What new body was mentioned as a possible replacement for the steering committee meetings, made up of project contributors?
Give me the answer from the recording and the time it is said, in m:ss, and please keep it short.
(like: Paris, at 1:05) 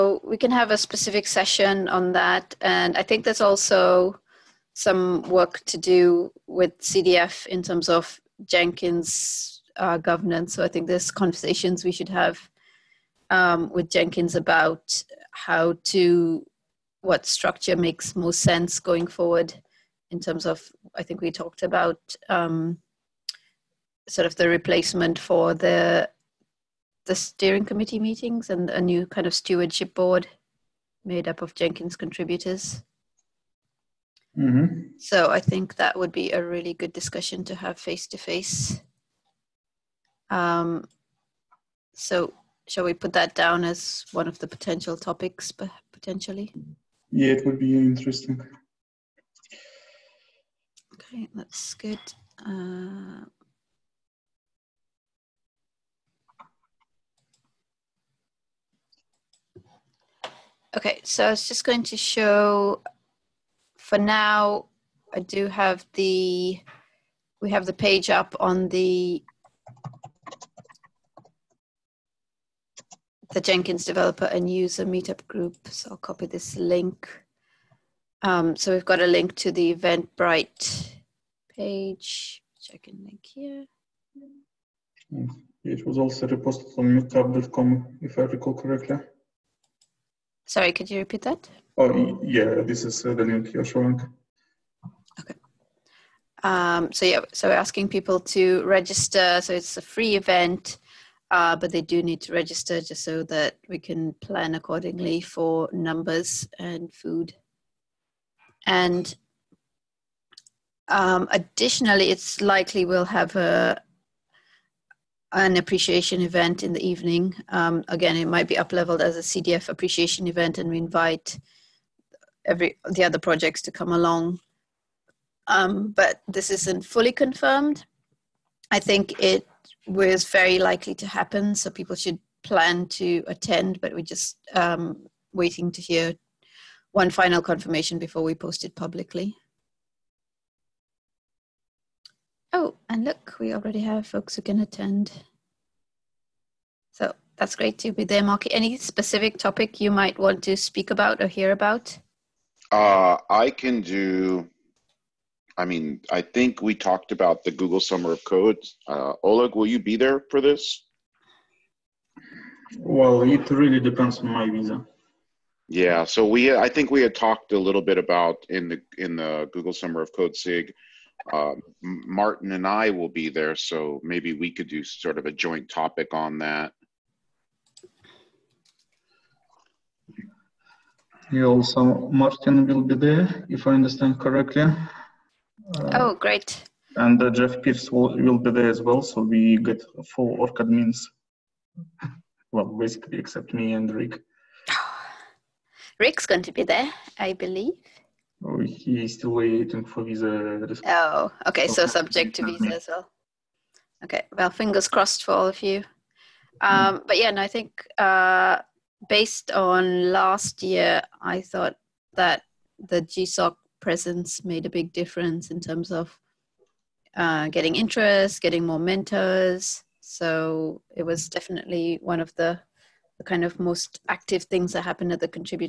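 Stewardship board, at 0:29.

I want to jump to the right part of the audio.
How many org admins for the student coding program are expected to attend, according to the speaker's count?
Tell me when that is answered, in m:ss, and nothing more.
3:10.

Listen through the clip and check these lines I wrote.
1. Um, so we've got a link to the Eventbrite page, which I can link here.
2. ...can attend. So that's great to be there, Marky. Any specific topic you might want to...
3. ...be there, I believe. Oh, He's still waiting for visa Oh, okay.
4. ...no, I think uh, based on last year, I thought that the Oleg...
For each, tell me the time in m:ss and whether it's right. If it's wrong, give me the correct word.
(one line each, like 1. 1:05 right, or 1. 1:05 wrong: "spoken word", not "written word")
1. 1:18 right
2. 2:24 right
3. 3:16 right
4. 3:27 wrong: "GSOC", not "Oleg".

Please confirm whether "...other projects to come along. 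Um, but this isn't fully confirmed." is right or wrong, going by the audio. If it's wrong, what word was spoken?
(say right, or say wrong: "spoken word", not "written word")
right.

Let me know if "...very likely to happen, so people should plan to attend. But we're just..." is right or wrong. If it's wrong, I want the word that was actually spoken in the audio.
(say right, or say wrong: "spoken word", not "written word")
right.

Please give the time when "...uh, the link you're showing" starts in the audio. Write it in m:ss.
1:33.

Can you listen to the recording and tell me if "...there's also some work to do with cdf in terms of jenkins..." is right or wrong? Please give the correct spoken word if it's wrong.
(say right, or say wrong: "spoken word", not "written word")
right.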